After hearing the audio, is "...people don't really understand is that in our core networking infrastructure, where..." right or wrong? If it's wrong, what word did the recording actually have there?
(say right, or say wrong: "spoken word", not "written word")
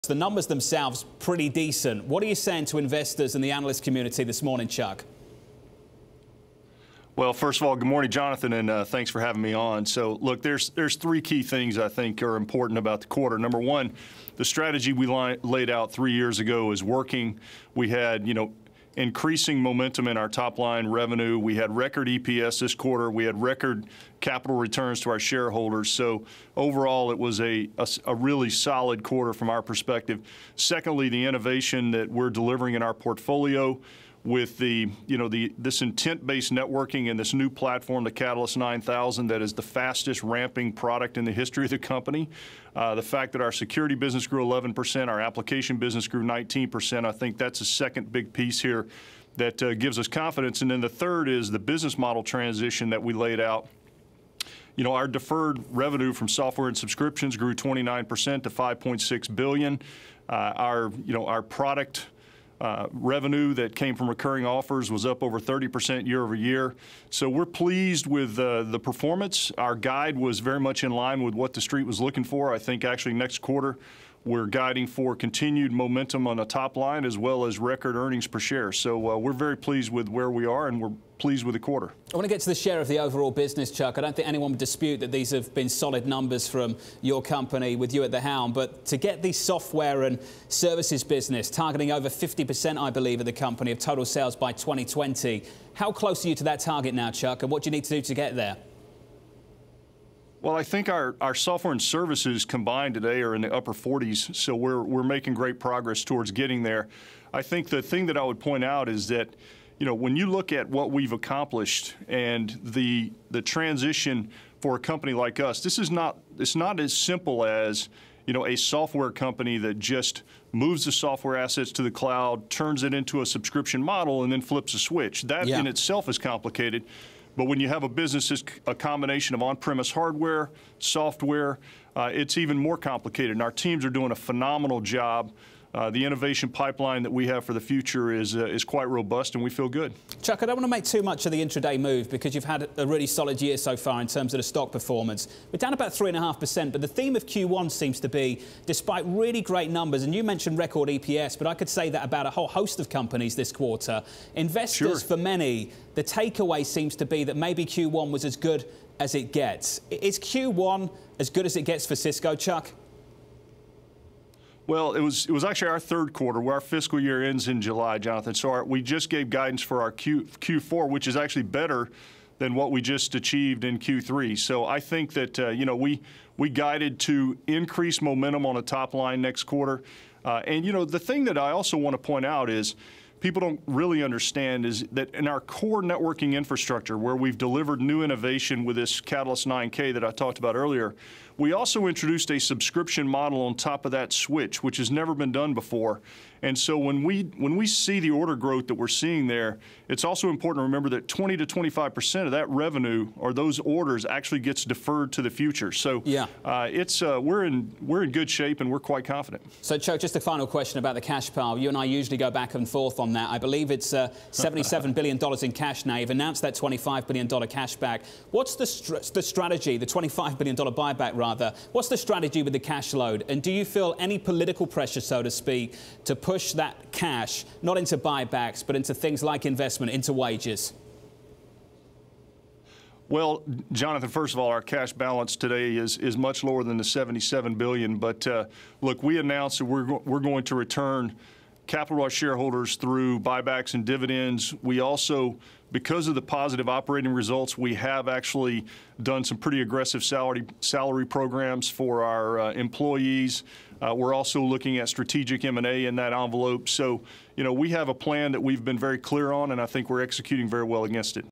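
right.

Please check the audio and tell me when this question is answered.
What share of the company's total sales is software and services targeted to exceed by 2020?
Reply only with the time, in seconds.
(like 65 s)
92 s.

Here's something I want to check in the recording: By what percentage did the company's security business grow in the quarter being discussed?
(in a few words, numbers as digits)
11%.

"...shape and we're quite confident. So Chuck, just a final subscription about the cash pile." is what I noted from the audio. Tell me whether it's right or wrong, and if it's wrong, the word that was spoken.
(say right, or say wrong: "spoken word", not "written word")
wrong: "question", not "subscription".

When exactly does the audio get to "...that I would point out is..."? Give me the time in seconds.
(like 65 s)
108 s.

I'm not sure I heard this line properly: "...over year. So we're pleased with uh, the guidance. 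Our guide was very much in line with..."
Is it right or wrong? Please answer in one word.
wrong.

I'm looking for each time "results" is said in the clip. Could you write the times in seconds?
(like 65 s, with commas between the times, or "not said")
247 s.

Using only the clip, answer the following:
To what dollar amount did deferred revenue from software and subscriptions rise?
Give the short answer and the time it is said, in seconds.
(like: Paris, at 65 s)
5.6 billion, at 58 s.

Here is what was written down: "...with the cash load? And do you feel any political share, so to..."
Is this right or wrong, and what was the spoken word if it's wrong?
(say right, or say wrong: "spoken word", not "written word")
wrong: "pressure", not "share".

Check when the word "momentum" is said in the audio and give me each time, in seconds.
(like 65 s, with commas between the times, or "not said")
19 s, 75 s, 178 s.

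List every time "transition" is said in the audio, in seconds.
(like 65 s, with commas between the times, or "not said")
52 s, 113 s.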